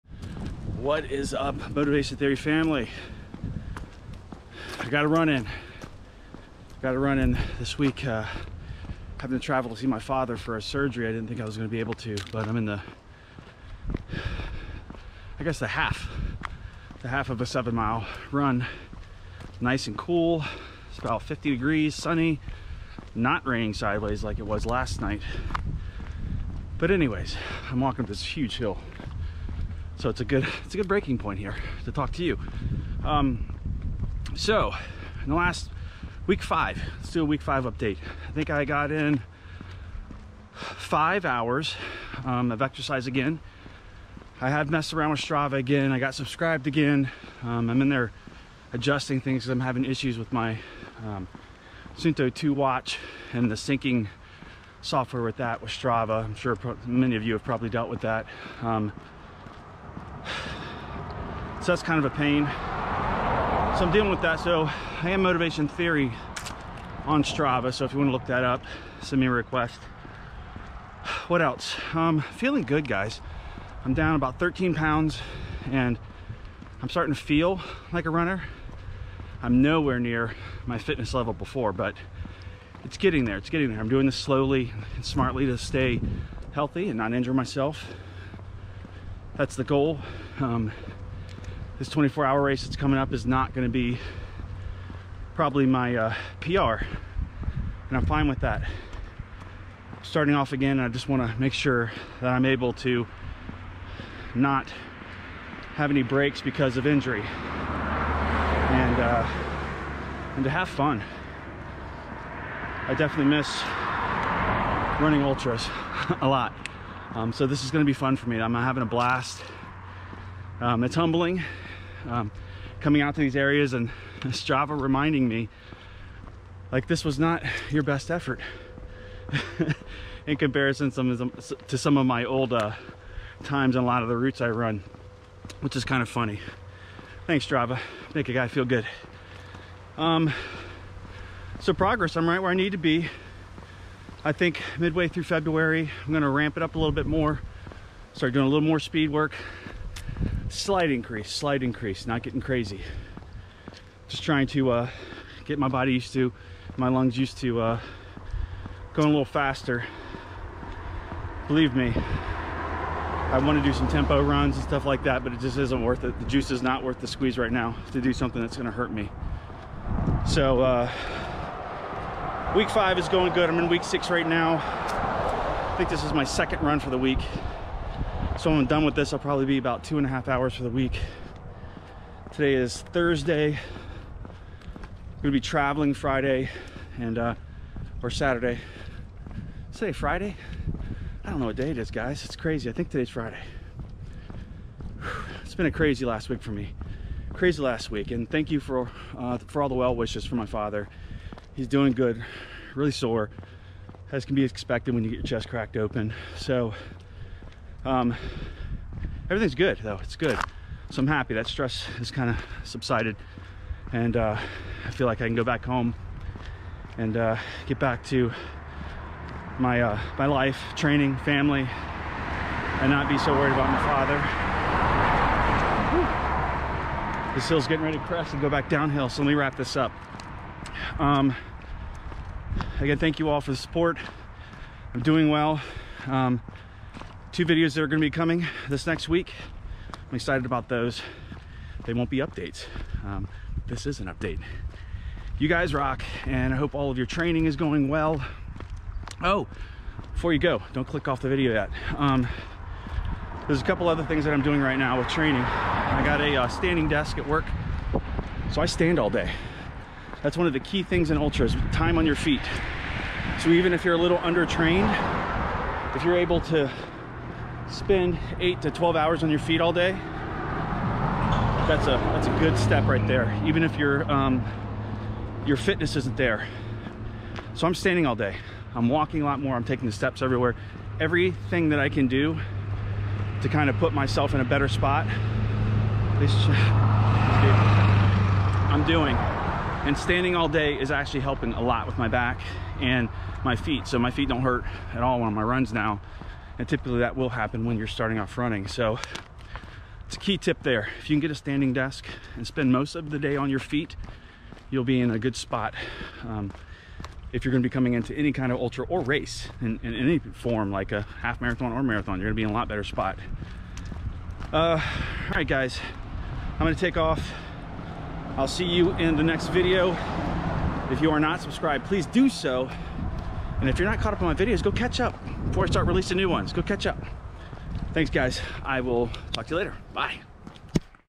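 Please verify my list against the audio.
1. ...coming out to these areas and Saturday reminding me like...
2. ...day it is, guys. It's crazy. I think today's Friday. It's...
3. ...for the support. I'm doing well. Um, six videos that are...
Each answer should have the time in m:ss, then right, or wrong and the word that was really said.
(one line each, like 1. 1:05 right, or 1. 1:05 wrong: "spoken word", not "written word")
1. 2:02 wrong: "Strava", not "Saturday"
2. 3:11 right
3. 3:53 wrong: "two", not "six".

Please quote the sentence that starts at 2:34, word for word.
Just trying to uh, get my body used to, my lungs used to uh, going a little faster.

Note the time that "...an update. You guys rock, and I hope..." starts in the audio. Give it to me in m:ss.
4:04.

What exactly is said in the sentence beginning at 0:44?
I have messed around with Strava again.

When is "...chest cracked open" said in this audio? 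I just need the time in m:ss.
3:25.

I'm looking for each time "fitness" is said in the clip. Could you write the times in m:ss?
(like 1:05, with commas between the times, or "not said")
1:20, 4:35.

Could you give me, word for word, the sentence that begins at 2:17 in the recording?
Thanks Strava, make a guy feel good.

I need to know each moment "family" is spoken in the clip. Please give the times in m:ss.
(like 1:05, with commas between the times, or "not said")
0:02, 3:41.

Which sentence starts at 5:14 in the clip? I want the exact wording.
Uh, all right, guys, I'm going to take off.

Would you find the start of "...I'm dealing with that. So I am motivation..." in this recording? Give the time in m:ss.
1:03.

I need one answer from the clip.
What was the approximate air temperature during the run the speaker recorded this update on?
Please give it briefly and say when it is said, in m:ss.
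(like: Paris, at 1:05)
50 degrees, at 0:21.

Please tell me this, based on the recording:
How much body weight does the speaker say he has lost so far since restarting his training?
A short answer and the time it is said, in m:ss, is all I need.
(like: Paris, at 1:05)
13 pounds, at 1:14.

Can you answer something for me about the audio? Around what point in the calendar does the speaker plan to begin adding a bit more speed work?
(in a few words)
midway through February.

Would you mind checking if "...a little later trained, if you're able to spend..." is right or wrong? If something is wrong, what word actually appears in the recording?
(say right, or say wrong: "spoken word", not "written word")
wrong: "under", not "later".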